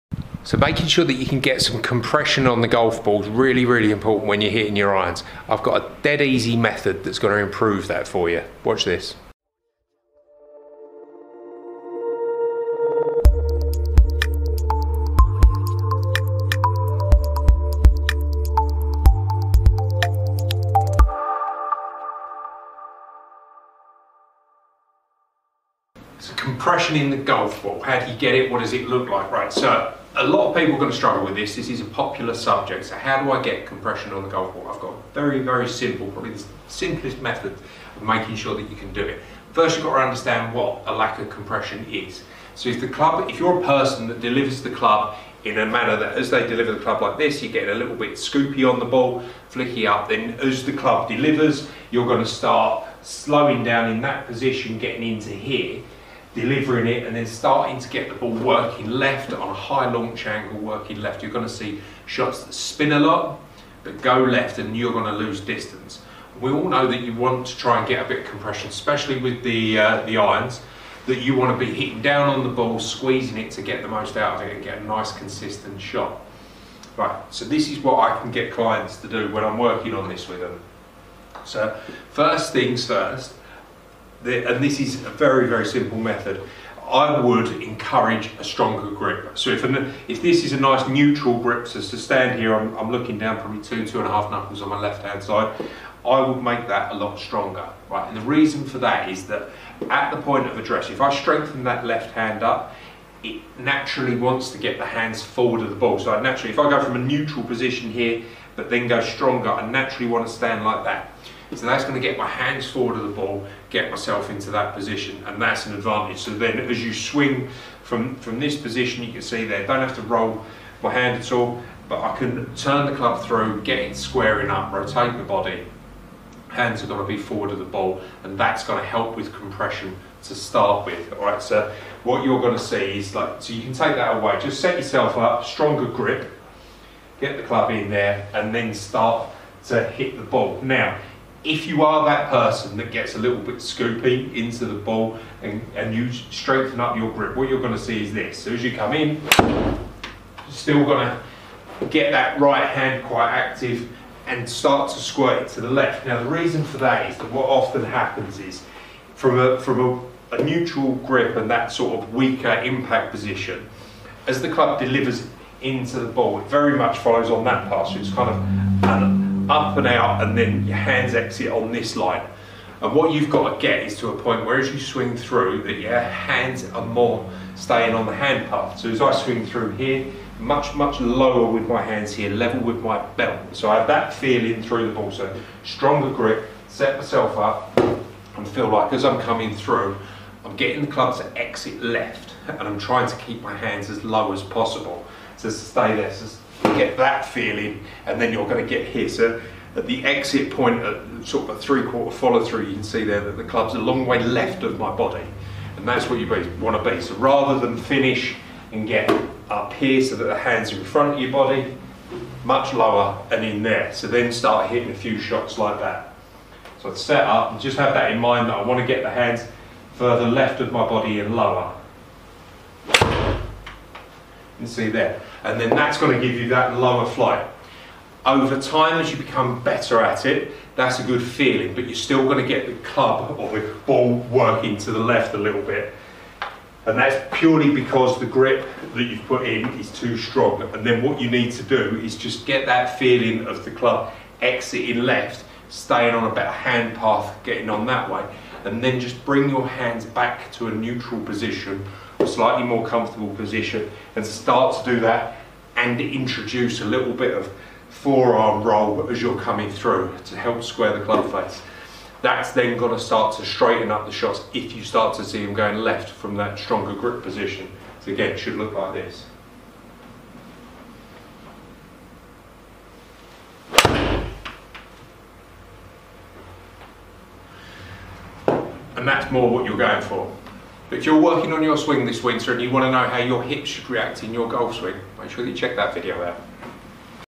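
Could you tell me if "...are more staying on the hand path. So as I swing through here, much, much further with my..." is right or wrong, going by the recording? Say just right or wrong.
wrong.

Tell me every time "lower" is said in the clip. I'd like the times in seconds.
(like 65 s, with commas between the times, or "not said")
181 s, 212 s, 221 s, 226 s.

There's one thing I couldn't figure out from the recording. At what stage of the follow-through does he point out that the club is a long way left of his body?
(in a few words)
Three-quarter follow-through.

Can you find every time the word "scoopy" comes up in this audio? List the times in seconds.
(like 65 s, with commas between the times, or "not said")
48 s, 143 s.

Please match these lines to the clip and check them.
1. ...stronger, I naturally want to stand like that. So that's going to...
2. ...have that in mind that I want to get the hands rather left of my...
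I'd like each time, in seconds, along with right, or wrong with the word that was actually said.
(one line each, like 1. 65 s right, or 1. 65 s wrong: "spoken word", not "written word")
1. 108 s right
2. 217 s wrong: "further", not "rather".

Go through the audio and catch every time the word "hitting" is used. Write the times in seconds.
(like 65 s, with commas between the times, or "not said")
4 s, 71 s, 214 s.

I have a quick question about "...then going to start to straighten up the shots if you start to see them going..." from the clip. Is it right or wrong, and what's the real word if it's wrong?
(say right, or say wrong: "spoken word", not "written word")
right.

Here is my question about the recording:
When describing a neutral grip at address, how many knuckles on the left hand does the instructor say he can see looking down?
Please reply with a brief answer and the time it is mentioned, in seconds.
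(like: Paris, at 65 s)
2 to 2.5, at 93 s.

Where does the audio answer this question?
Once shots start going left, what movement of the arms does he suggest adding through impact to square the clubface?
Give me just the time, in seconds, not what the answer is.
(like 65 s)
257 s.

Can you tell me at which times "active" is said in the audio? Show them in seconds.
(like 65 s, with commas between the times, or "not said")
153 s.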